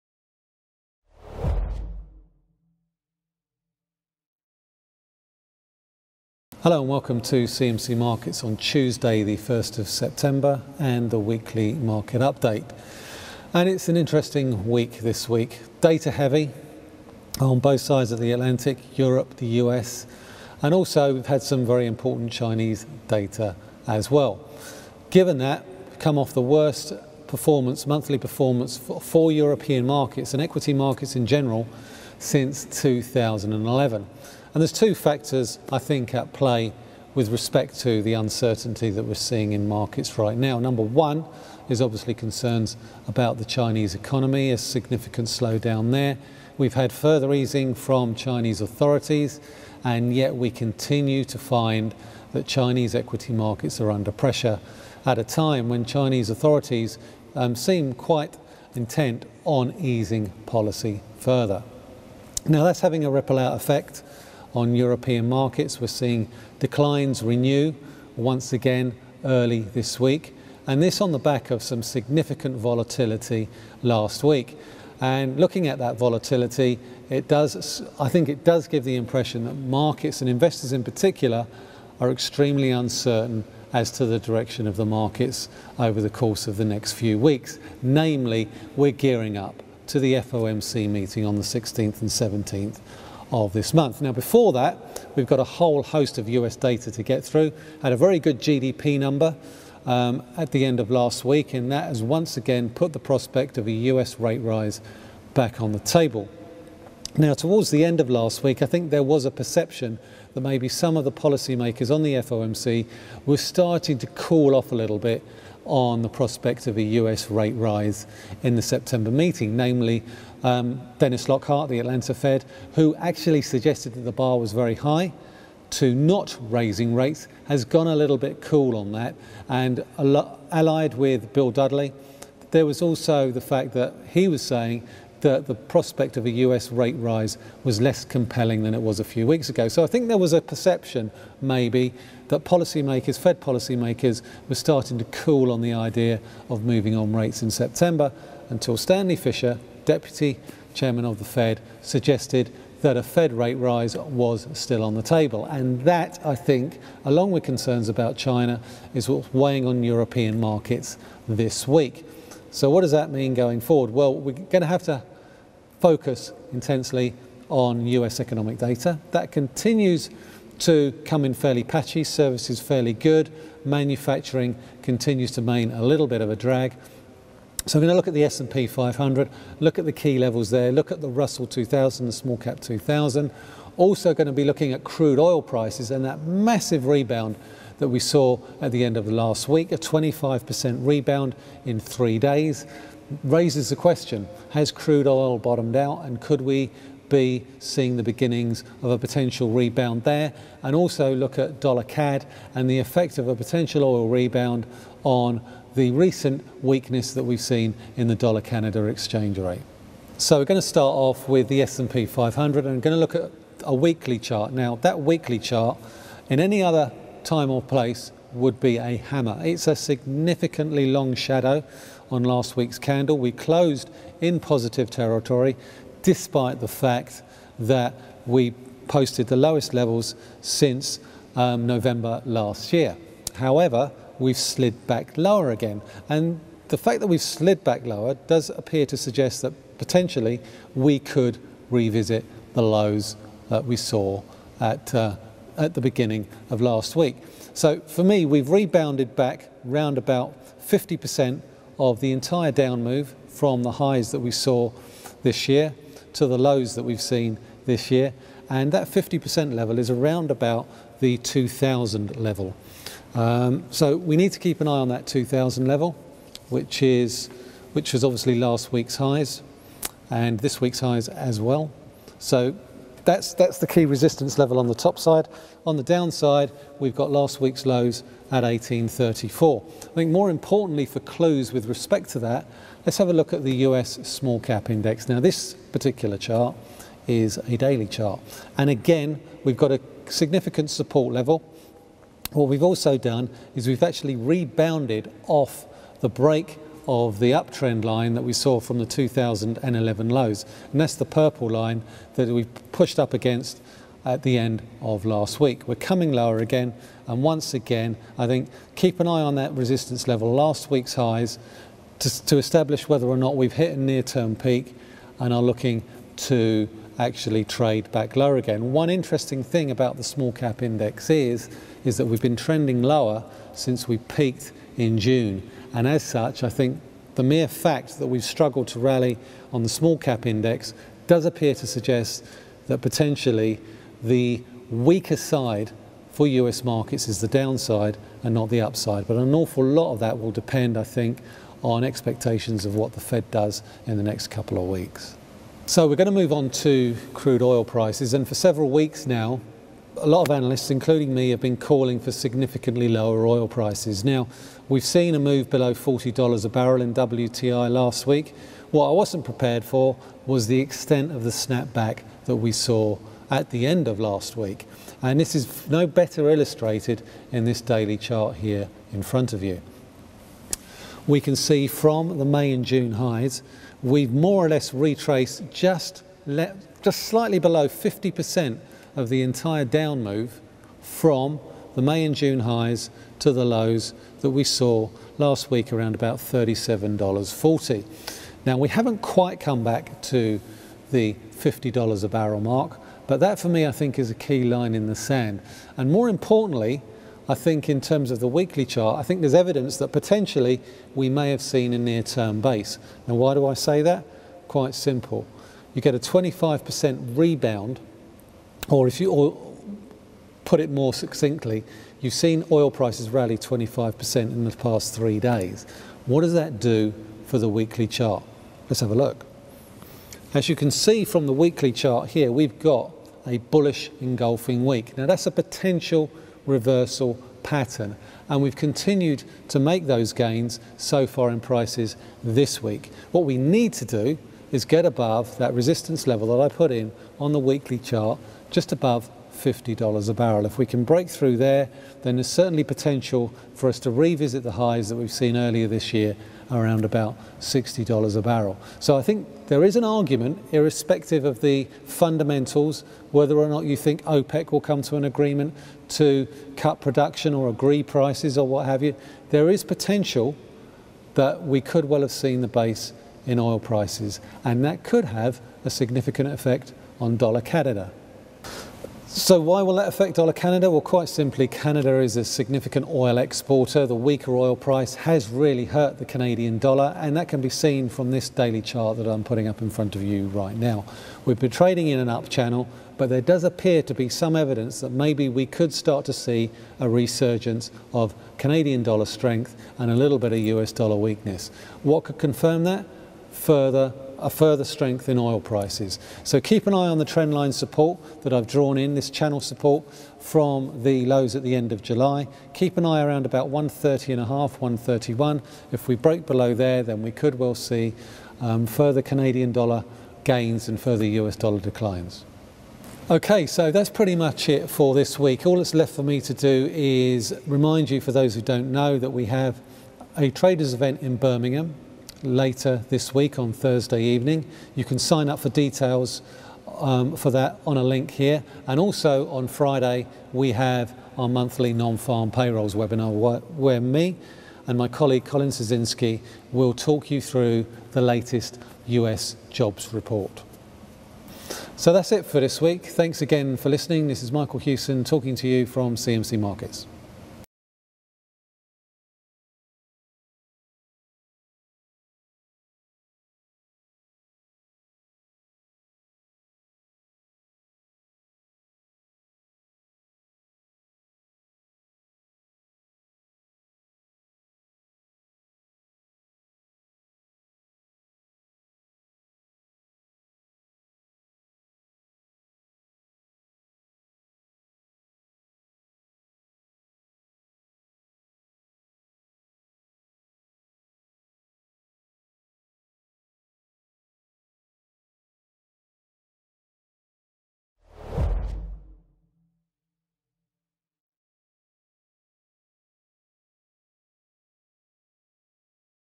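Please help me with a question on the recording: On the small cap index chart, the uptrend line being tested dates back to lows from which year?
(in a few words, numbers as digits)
2011.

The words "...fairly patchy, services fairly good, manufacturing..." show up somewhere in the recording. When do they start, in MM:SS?
02:51.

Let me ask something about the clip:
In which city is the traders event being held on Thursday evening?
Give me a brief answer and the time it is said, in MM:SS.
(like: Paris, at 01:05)
Birmingham, at 08:41.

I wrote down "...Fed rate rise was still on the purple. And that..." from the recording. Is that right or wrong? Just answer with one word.
wrong.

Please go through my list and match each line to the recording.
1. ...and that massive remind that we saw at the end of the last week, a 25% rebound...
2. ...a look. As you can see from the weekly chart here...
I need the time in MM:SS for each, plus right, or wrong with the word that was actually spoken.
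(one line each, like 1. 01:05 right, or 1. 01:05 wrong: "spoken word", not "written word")
1. 03:05 wrong: "rebound", not "remind"
2. 06:58 right.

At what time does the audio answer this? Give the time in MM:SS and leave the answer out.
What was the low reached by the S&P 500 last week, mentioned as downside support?
04:38.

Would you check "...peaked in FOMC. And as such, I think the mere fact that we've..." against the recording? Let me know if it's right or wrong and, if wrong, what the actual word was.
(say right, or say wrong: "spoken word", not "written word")
wrong: "June", not "FOMC".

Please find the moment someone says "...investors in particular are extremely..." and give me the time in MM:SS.
01:20.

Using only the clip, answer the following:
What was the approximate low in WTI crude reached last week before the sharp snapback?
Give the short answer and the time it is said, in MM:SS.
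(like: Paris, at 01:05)
$37.40, at 06:26.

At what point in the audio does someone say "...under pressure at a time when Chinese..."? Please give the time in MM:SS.
00:53.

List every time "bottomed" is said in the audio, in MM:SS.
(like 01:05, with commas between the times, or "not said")
03:15.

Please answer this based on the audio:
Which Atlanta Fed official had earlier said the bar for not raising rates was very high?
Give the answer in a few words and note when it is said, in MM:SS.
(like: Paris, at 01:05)
Dennis Lockhart, at 02:00.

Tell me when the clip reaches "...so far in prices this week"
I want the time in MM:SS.
07:10.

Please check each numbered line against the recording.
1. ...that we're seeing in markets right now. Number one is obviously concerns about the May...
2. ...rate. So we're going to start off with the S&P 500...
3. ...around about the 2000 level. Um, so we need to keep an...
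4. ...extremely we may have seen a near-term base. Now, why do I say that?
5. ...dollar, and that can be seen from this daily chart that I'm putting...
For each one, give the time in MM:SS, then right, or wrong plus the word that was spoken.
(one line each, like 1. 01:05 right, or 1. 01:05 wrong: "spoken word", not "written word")
1. 00:38 wrong: "Chinese", not "May"
2. 03:29 right
3. 04:19 right
4. 06:39 wrong: "potentially", not "extremely"
5. 07:56 right.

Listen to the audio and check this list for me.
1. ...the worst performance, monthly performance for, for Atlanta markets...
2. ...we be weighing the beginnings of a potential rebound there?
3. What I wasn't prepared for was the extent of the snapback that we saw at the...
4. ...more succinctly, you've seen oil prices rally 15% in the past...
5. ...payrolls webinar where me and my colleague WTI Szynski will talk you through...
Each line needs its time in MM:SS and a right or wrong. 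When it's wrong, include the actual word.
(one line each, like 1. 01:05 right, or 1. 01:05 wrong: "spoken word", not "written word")
1. 00:26 wrong: "European", not "Atlanta"
2. 03:16 wrong: "seeing", not "weighing"
3. 05:58 right
4. 06:50 wrong: "25", not "15"
5. 08:52 wrong: "Colin", not "WTI".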